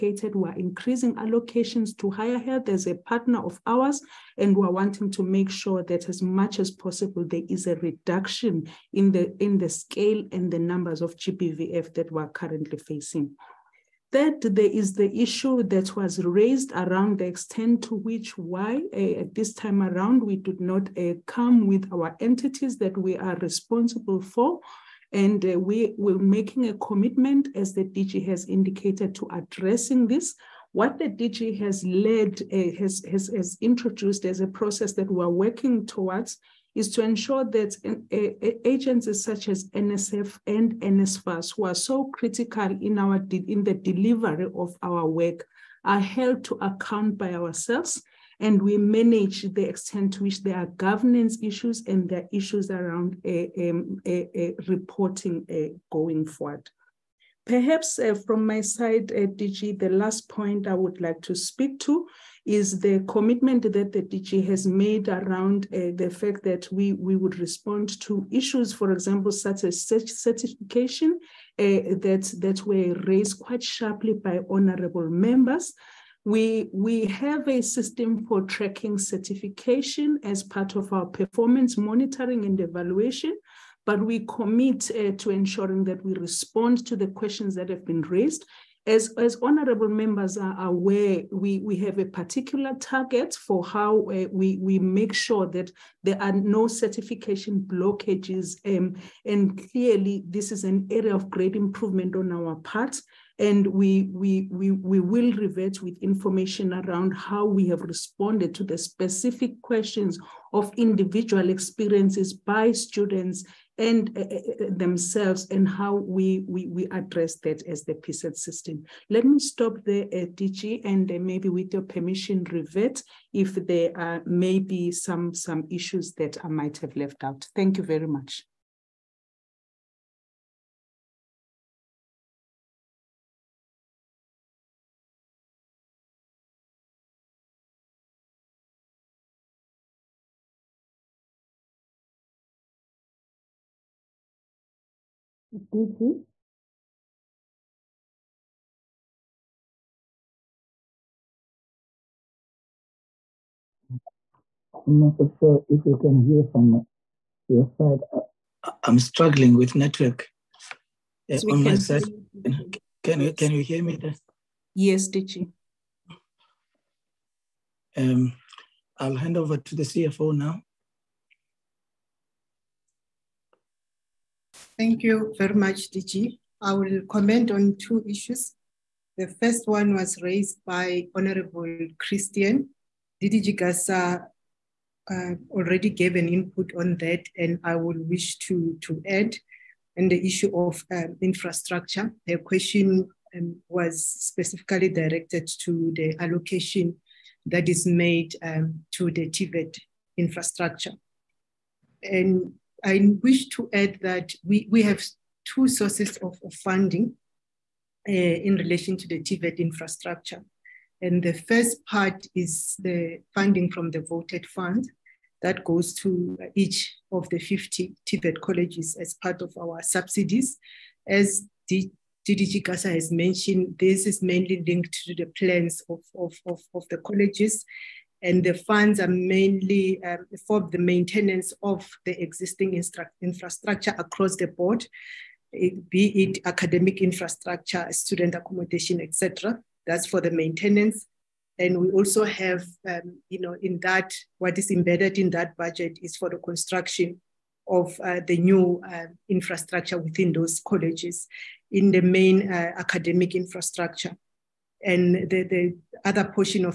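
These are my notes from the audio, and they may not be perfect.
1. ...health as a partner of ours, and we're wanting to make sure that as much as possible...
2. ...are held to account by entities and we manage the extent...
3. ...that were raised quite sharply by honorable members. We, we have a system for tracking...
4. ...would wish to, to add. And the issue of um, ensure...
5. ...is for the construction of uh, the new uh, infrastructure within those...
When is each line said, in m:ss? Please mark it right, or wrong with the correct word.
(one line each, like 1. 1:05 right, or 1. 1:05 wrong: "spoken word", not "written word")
1. 0:02 right
2. 0:45 wrong: "ourselves", not "entities"
3. 1:12 right
4. 3:07 wrong: "infrastructure", not "ensure"
5. 4:06 right.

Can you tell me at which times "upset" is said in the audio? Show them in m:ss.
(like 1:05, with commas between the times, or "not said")
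not said.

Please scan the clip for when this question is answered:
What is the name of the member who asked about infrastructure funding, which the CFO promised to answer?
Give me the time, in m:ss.
3:01.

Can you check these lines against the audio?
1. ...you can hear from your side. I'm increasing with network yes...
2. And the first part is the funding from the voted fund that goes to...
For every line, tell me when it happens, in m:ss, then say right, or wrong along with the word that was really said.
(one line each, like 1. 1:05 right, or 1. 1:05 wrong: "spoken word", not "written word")
1. 2:35 wrong: "struggling", not "increasing"
2. 3:31 right.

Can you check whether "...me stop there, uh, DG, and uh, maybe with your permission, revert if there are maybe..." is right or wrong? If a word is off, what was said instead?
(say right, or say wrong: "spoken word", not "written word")
right.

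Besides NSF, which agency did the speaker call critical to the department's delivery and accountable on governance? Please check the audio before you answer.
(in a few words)
NSFAS.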